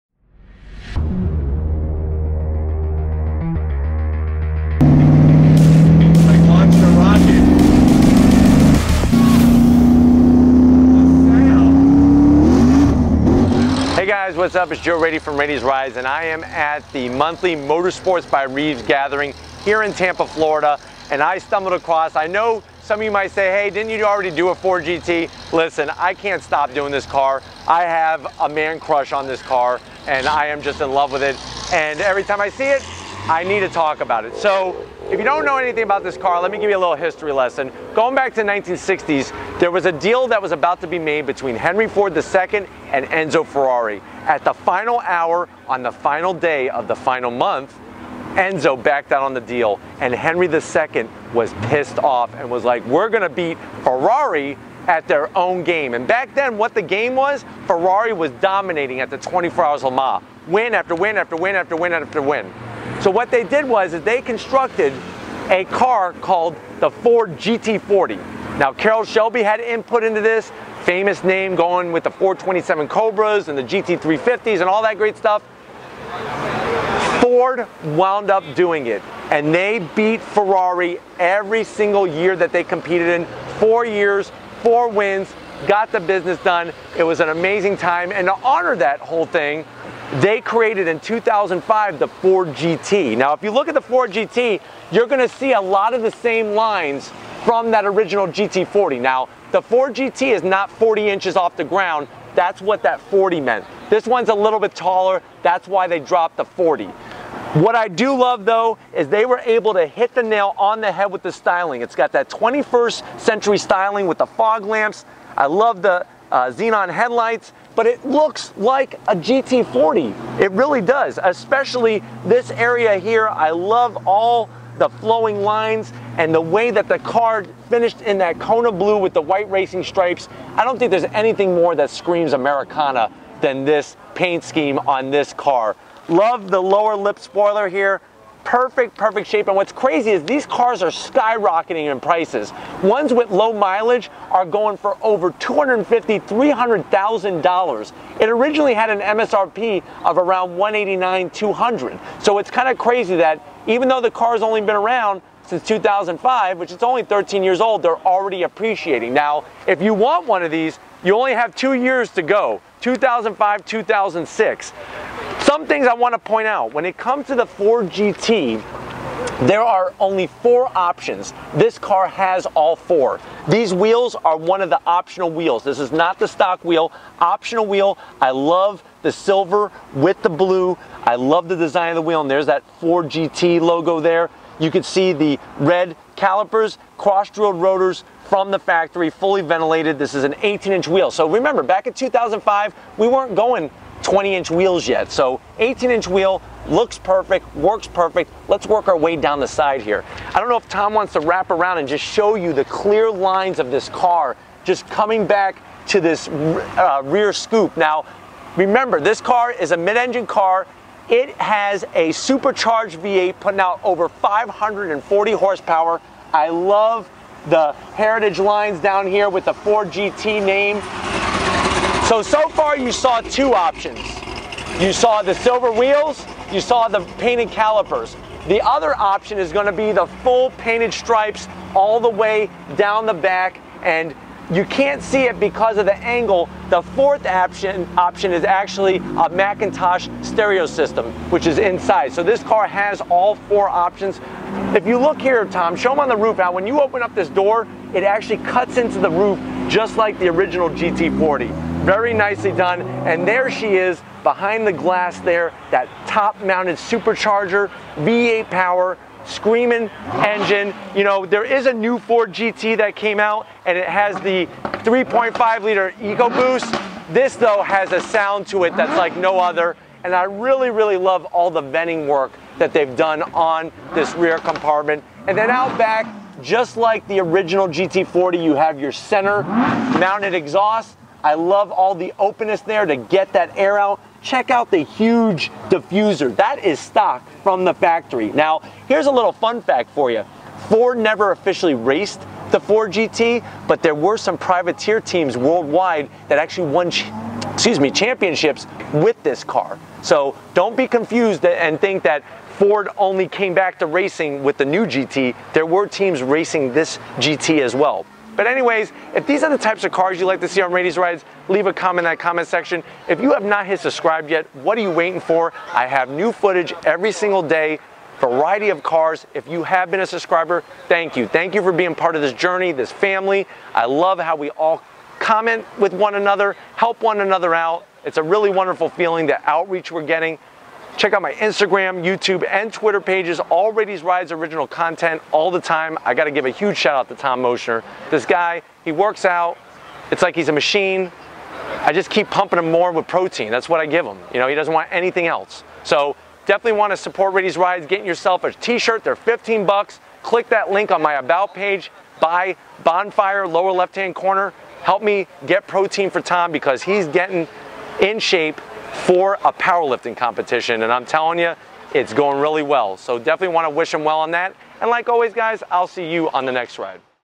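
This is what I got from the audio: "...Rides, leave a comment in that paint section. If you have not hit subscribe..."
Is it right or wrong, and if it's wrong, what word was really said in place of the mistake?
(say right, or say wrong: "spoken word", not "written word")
wrong: "comment", not "paint".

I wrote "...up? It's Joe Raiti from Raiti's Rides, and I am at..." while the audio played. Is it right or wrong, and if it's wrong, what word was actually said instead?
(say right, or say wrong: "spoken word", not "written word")
right.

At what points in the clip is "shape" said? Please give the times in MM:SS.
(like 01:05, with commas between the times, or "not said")
02:19, 05:58.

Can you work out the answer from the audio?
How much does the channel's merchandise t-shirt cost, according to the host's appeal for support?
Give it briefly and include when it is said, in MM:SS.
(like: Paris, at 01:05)
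$15, at 05:49.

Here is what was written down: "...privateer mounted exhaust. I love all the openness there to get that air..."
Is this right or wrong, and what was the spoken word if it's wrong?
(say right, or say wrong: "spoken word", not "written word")
wrong: "center", not "privateer".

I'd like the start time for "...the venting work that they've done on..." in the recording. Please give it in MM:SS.
04:31.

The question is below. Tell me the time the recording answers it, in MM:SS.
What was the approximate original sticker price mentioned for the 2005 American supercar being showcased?
02:30.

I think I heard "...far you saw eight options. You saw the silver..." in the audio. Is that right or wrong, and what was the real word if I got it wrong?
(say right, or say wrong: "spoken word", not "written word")
wrong: "two", not "eight".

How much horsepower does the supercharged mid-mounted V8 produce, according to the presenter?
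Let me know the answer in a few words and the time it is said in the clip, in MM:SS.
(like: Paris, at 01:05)
over 540, at 03:33.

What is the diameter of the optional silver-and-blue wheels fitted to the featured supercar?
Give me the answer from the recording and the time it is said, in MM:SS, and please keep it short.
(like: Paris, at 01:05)
18 inches, at 03:10.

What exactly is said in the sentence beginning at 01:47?
What I do love though is they were able to hit the nail on the head with the styling.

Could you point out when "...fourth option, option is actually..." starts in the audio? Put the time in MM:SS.
03:56.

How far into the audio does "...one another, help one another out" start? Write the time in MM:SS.
05:25.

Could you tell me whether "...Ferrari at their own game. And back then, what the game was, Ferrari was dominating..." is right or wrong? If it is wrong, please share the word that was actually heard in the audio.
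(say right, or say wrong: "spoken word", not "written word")
right.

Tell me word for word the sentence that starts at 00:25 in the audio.
Listen, I can't stop doing this car.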